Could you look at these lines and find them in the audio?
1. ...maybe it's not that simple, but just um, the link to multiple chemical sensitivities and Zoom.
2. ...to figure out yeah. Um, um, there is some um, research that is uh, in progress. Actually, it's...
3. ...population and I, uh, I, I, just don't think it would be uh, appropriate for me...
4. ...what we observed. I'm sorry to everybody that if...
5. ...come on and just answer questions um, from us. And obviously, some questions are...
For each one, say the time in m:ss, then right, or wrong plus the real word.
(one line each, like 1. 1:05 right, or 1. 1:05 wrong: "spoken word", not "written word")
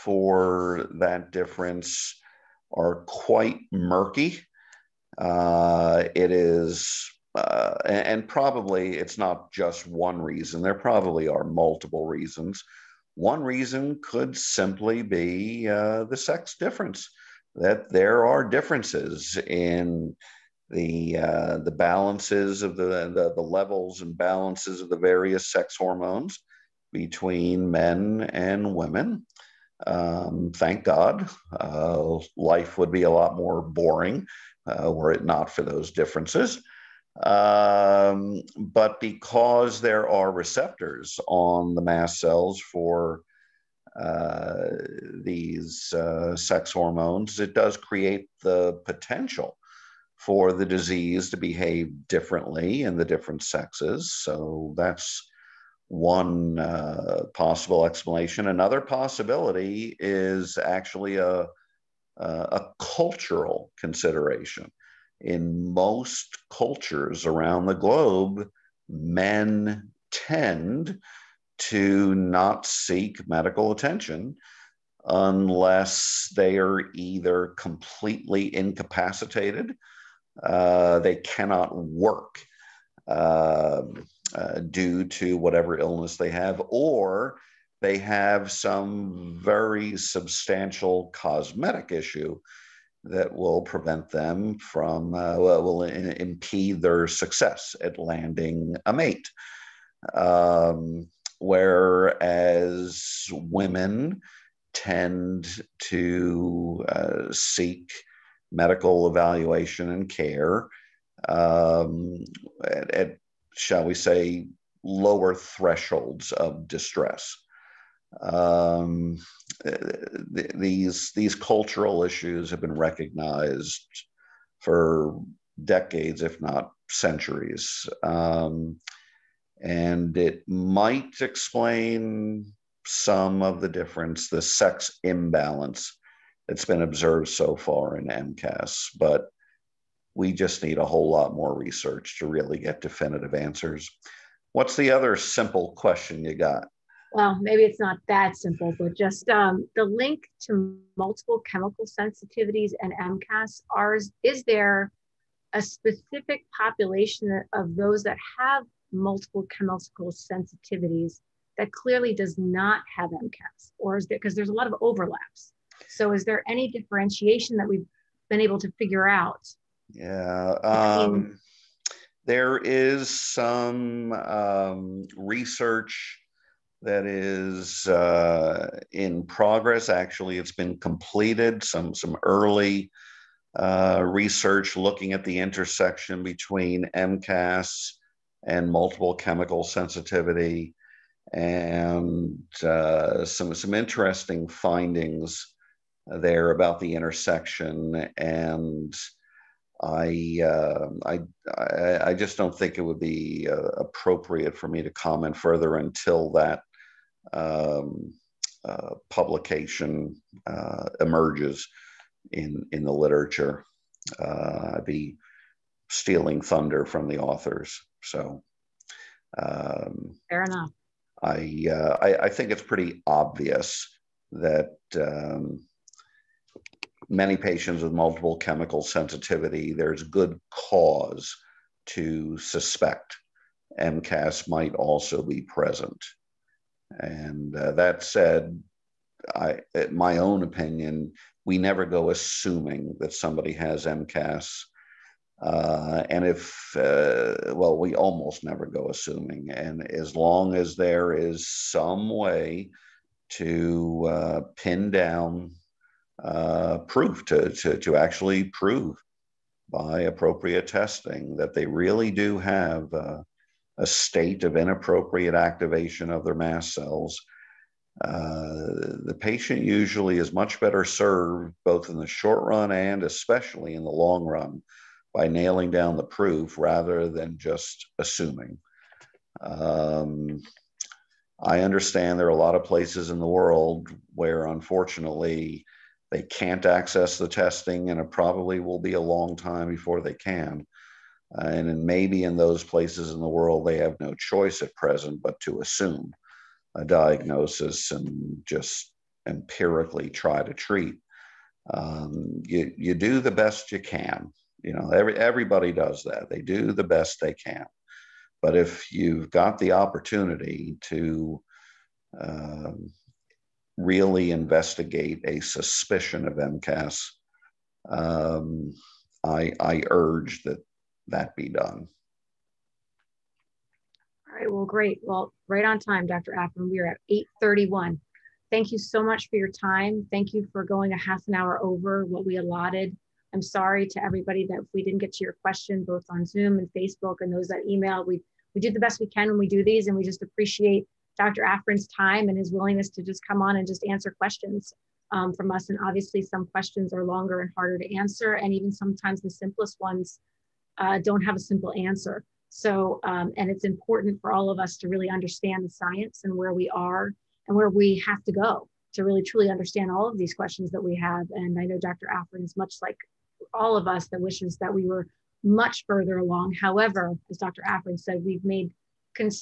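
1. 2:27 wrong: "MCAS", not "Zoom"
2. 2:48 right
3. 3:16 wrong: "intersection", not "population"
4. 5:32 wrong: "allotted", not "observed"
5. 5:43 right.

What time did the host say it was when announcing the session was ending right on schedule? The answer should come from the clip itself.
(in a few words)
8:31.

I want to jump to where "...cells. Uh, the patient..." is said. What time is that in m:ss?
4:26.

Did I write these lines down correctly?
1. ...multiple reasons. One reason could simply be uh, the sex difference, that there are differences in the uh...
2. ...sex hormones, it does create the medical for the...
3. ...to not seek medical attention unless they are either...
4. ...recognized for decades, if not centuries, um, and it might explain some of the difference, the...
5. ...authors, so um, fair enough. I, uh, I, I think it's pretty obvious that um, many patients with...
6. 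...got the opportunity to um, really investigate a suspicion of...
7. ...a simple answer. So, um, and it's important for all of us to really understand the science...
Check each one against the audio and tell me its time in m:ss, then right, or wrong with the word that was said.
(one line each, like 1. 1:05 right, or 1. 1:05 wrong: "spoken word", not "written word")
1. 0:11 right
2. 0:46 wrong: "potential", not "medical"
3. 1:11 right
4. 2:02 right
5. 3:37 right
6. 5:09 right
7. 5:51 right.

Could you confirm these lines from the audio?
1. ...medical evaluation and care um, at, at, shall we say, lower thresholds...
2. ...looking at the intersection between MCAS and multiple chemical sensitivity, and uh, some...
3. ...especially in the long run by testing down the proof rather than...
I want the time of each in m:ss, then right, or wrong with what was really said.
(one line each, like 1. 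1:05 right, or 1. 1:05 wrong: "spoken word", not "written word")
1. 1:48 right
2. 3:04 right
3. 4:33 wrong: "nailing", not "testing".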